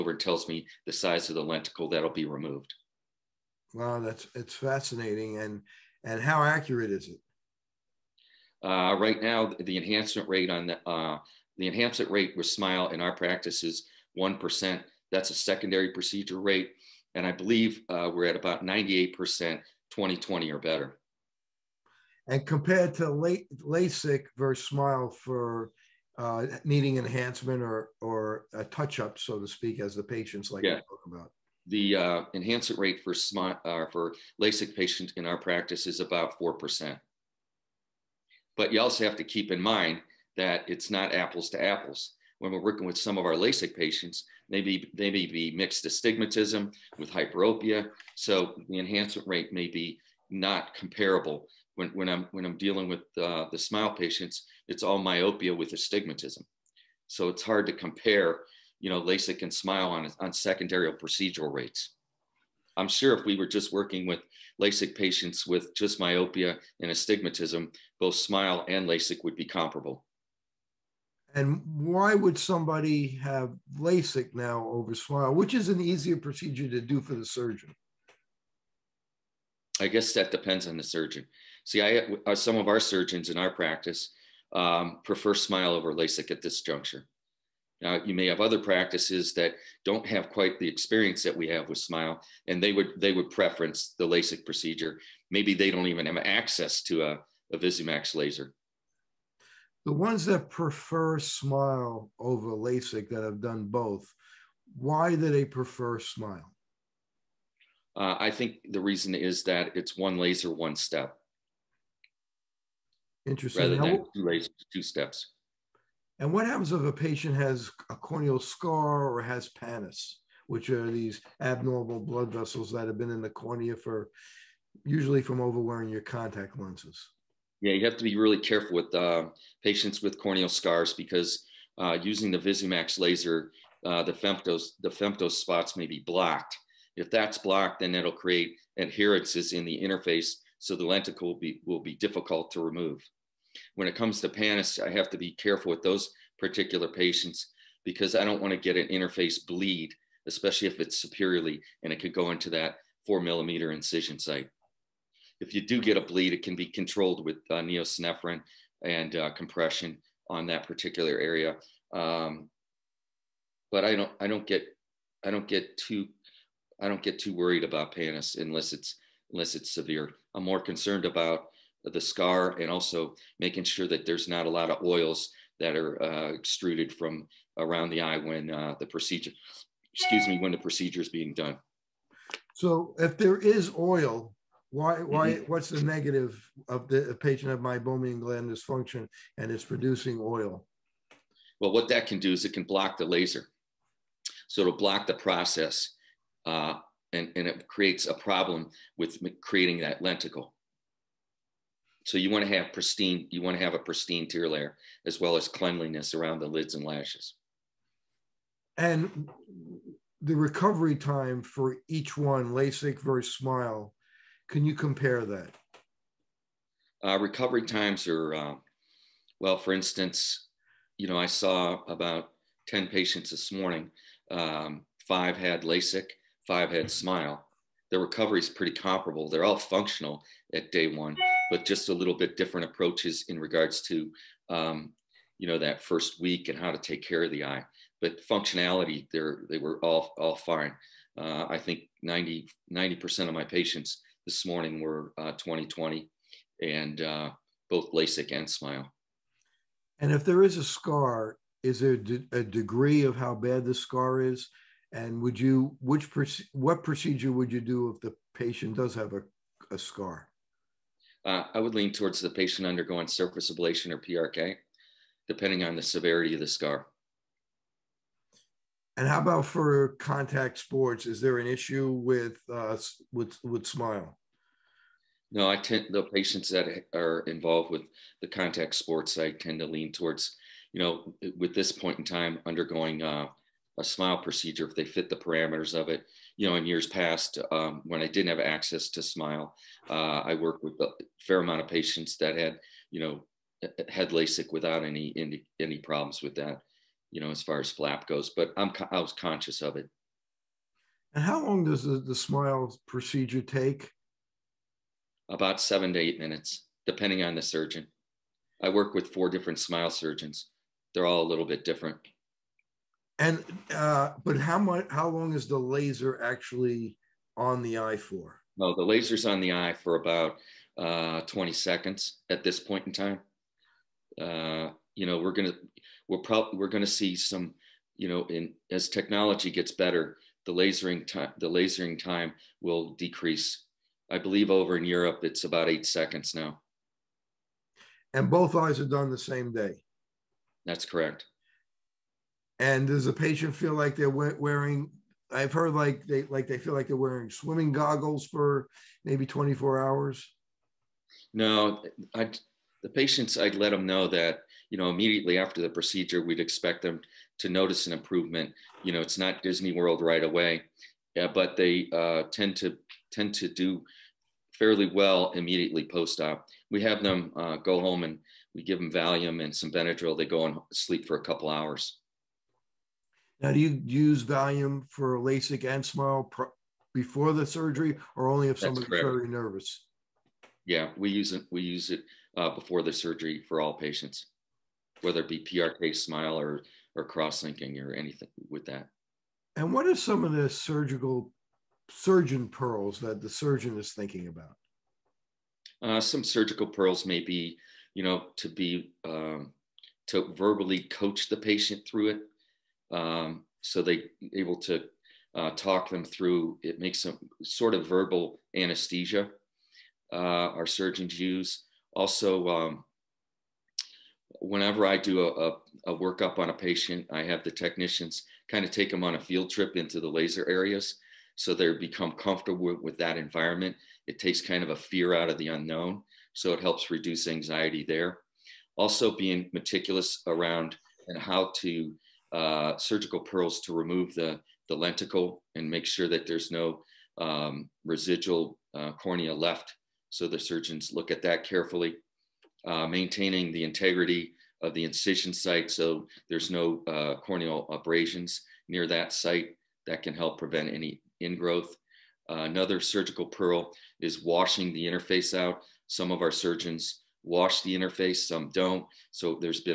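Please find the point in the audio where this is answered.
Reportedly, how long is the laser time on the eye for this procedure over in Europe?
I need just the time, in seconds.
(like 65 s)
335 s.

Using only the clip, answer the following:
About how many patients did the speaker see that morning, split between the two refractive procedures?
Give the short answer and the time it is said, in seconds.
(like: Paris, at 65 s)
10, at 222 s.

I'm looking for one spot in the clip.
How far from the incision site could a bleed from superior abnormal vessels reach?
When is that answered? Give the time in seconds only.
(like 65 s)
153 s.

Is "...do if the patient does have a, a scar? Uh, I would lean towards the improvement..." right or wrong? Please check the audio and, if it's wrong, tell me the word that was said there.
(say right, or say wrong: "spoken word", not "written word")
wrong: "patient", not "improvement".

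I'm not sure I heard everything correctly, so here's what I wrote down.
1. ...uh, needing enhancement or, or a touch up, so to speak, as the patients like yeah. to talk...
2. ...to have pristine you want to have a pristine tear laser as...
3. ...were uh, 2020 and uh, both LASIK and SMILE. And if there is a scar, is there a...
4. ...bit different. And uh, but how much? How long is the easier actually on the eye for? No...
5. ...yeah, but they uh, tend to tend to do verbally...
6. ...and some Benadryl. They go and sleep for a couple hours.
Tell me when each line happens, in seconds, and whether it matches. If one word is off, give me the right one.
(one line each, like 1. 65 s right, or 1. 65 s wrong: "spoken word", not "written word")
1. 26 s right
2. 202 s wrong: "layer", not "laser"
3. 244 s right
4. 311 s wrong: "laser", not "easier"
5. 361 s wrong: "fairly", not "verbally"
6. 369 s right.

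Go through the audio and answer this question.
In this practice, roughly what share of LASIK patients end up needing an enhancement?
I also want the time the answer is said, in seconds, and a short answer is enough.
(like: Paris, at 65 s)
4%, at 36 s.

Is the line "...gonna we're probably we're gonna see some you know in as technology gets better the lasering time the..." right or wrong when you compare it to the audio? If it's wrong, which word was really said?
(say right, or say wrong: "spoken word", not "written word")
right.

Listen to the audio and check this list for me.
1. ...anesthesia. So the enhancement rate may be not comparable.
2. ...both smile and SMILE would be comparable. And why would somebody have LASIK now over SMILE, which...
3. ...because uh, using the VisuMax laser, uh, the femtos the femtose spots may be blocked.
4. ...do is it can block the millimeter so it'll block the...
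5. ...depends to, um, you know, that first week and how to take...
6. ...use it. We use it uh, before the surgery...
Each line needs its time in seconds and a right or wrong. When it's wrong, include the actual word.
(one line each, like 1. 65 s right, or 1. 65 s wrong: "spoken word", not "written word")
1. 47 s wrong: "hyperopia", not "anesthesia"
2. 68 s wrong: "LASIK", not "SMILE"
3. 130 s right
4. 192 s wrong: "laser", not "millimeter"
5. 233 s wrong: "regards", not "depends"
6. 381 s right.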